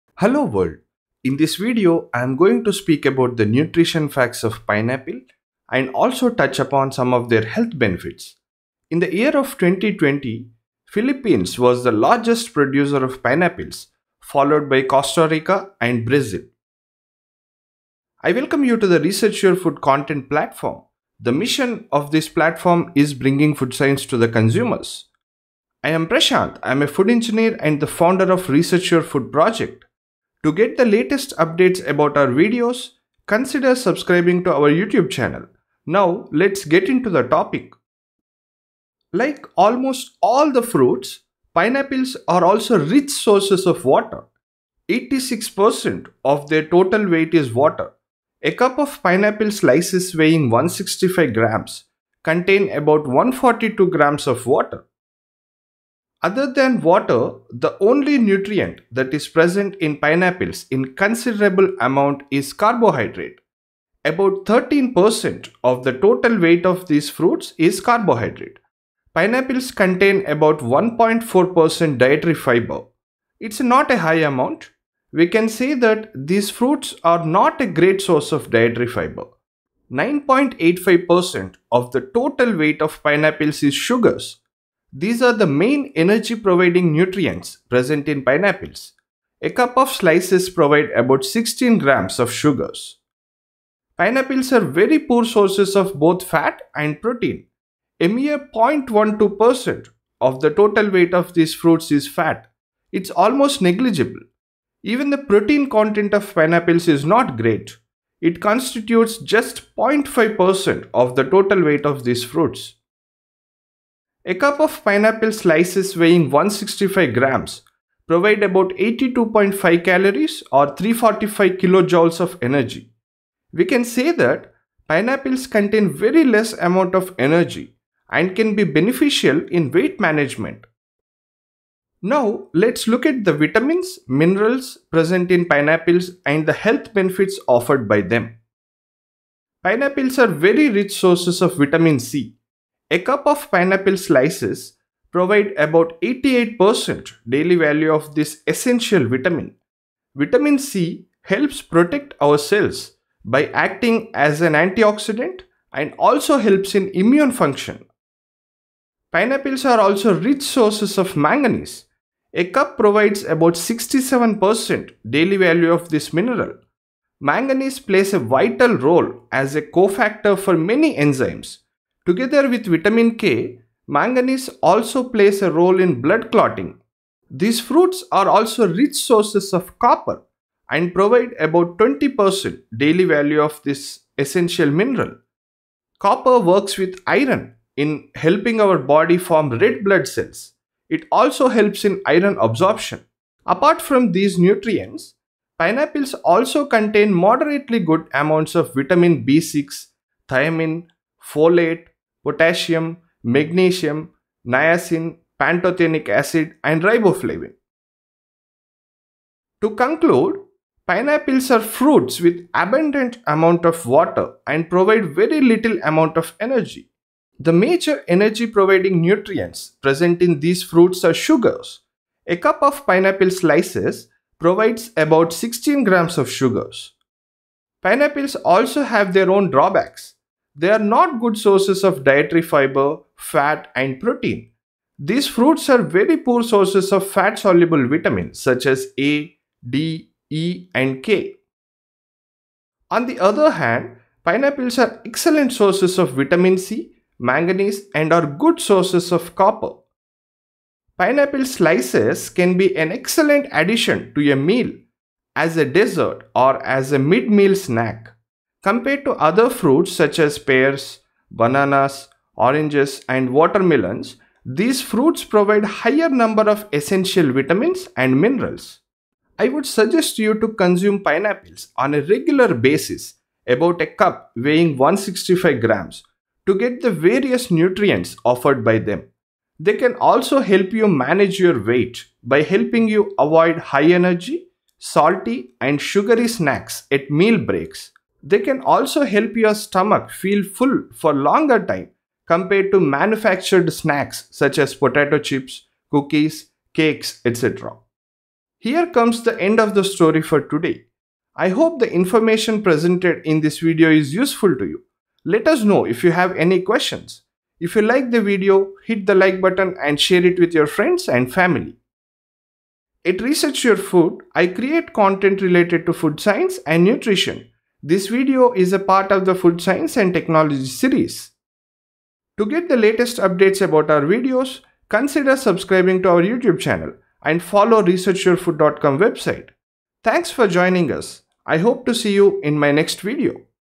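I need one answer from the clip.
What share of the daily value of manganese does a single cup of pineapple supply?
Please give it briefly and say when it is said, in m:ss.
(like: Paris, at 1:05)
67%, at 2:43.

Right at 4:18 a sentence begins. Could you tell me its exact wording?
Compared to other fruits such as pears, bananas, oranges and watermelons, these fruits provide higher number of essential vitamins and minerals.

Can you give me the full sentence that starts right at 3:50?
They are not good sources of dietary fiber, fat, and protein.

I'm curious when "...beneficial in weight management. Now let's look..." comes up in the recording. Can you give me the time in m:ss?
2:08.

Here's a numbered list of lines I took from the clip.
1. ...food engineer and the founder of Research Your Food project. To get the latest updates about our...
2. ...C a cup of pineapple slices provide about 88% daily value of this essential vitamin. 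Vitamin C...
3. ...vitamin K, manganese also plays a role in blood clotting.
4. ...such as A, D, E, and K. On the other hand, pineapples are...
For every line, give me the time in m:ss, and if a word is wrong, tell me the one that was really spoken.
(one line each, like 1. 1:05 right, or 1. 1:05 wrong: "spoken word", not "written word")
1. 0:26 right
2. 2:21 right
3. 2:52 right
4. 3:58 right.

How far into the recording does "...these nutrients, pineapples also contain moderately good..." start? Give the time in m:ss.
3:14.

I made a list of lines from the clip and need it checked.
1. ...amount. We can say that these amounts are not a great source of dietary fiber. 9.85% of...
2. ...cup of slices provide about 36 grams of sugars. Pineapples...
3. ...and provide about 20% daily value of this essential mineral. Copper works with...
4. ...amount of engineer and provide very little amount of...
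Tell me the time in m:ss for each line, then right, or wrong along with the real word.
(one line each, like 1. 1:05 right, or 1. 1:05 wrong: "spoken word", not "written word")
1. 1:14 wrong: "fruits", not "amounts"
2. 1:29 wrong: "16", not "36"
3. 3:00 right
4. 3:33 wrong: "water", not "engineer".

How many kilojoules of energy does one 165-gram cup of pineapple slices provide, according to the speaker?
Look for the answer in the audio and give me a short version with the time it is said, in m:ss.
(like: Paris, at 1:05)
345, at 2:00.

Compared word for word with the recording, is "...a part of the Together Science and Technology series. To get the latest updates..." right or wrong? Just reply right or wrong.
wrong.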